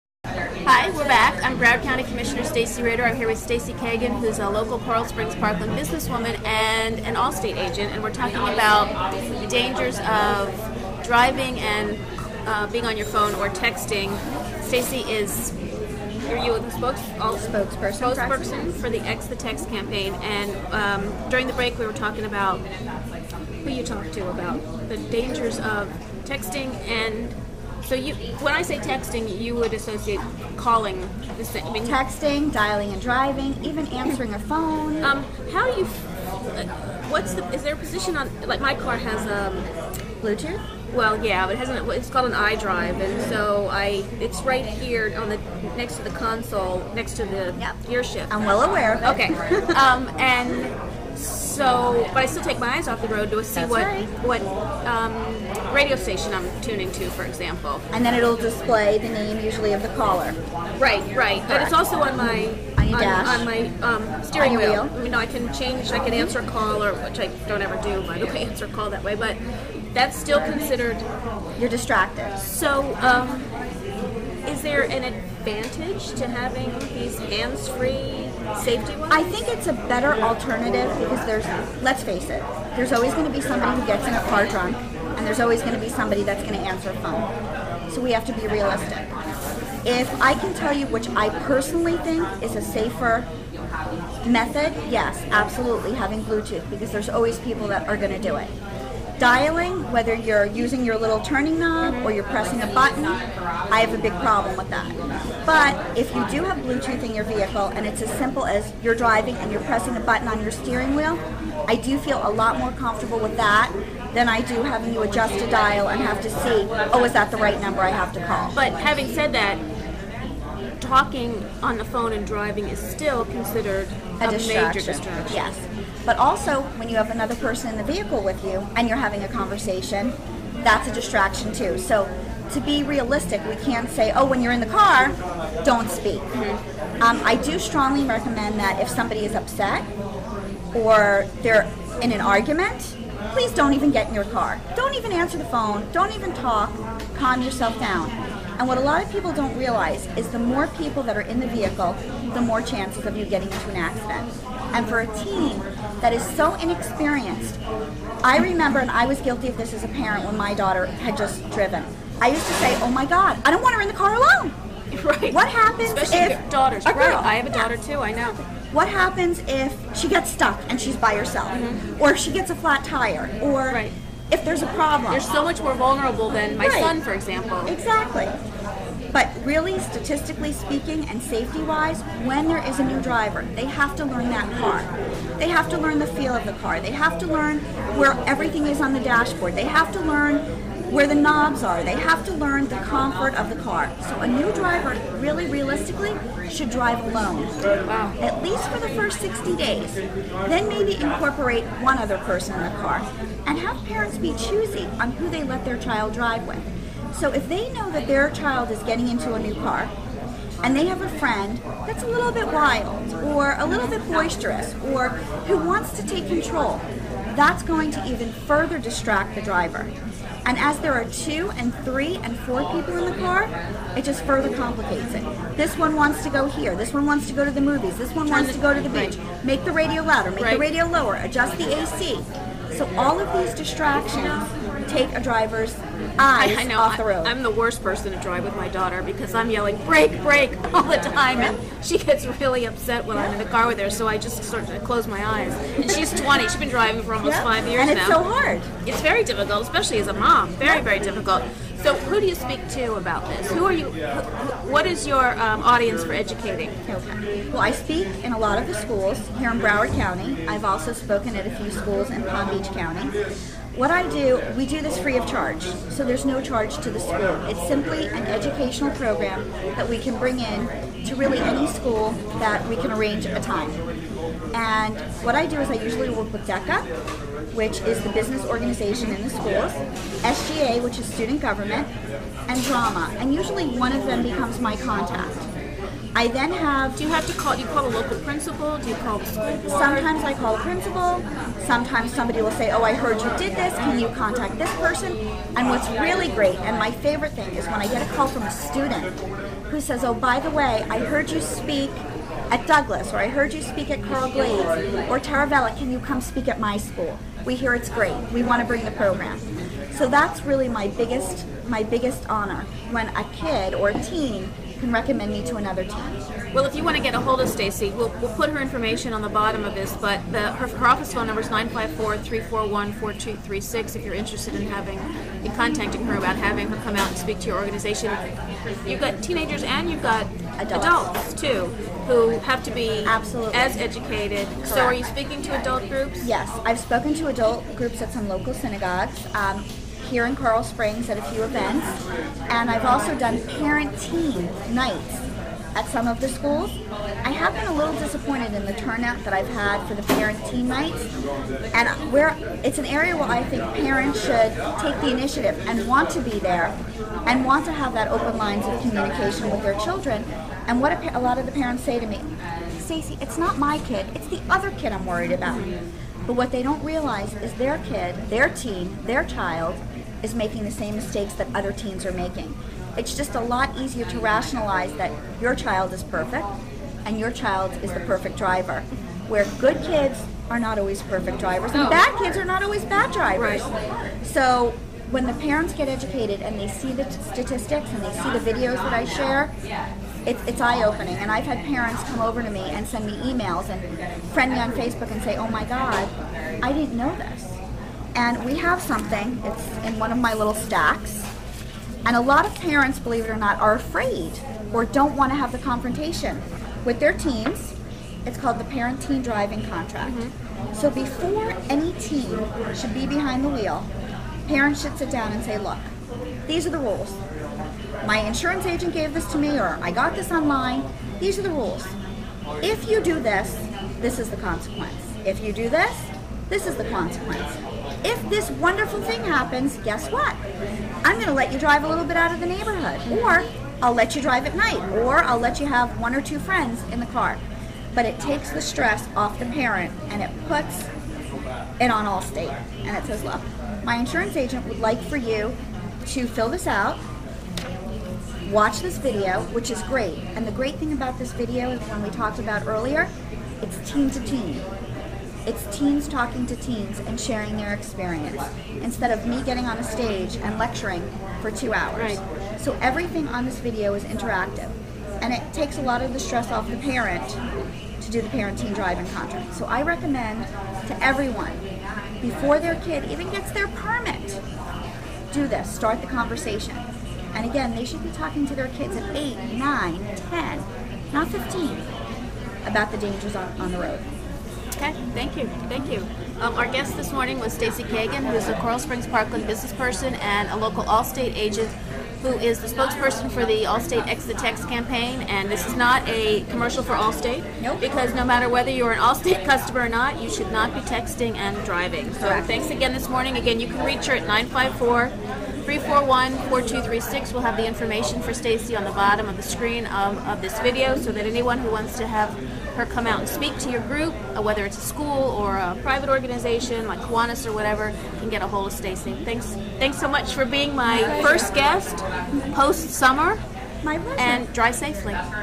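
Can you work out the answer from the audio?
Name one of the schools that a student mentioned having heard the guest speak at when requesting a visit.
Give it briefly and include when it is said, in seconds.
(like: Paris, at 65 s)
Douglas, at 302 s.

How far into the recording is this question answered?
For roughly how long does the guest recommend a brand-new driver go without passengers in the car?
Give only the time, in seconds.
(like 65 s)
199 s.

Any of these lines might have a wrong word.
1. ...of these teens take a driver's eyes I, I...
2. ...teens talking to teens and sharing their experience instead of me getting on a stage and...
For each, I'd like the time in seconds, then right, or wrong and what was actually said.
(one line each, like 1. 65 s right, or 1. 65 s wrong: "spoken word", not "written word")
1. 233 s wrong: "distractions", not "teens"
2. 455 s right.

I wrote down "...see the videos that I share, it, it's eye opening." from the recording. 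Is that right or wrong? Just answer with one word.
right.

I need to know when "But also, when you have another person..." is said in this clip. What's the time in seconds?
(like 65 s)
126 s.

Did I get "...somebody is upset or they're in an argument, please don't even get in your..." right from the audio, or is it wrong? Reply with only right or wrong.
right.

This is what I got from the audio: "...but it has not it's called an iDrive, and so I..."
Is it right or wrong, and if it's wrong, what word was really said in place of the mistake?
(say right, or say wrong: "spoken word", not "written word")
right.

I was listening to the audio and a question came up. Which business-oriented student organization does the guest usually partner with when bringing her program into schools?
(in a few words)
DECA.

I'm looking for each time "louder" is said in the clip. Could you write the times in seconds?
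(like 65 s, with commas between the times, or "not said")
230 s.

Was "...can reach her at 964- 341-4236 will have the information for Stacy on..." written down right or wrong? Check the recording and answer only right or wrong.
wrong.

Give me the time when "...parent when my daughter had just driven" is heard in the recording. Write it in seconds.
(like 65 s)
159 s.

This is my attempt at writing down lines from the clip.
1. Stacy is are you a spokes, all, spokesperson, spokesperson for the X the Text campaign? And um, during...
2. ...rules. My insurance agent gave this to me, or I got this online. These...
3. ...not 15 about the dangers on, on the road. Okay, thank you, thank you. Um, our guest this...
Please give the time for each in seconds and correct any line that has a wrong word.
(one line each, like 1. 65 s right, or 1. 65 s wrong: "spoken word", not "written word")
1. 14 s right
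2. 416 s right
3. 481 s right.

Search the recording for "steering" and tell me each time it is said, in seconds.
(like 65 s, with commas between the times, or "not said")
64 s, 110 s.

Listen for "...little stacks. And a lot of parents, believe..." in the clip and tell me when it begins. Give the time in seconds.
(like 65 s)
400 s.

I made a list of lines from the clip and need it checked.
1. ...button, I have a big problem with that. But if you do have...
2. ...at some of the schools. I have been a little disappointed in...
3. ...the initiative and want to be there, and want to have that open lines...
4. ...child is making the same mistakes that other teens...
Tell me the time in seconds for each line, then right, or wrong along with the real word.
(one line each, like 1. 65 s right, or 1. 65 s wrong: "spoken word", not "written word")
1. 102 s right
2. 345 s right
3. 354 s right
4. 369 s right.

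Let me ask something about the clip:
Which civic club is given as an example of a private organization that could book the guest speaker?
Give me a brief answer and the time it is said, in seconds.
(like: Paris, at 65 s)
Kiwanis, at 516 s.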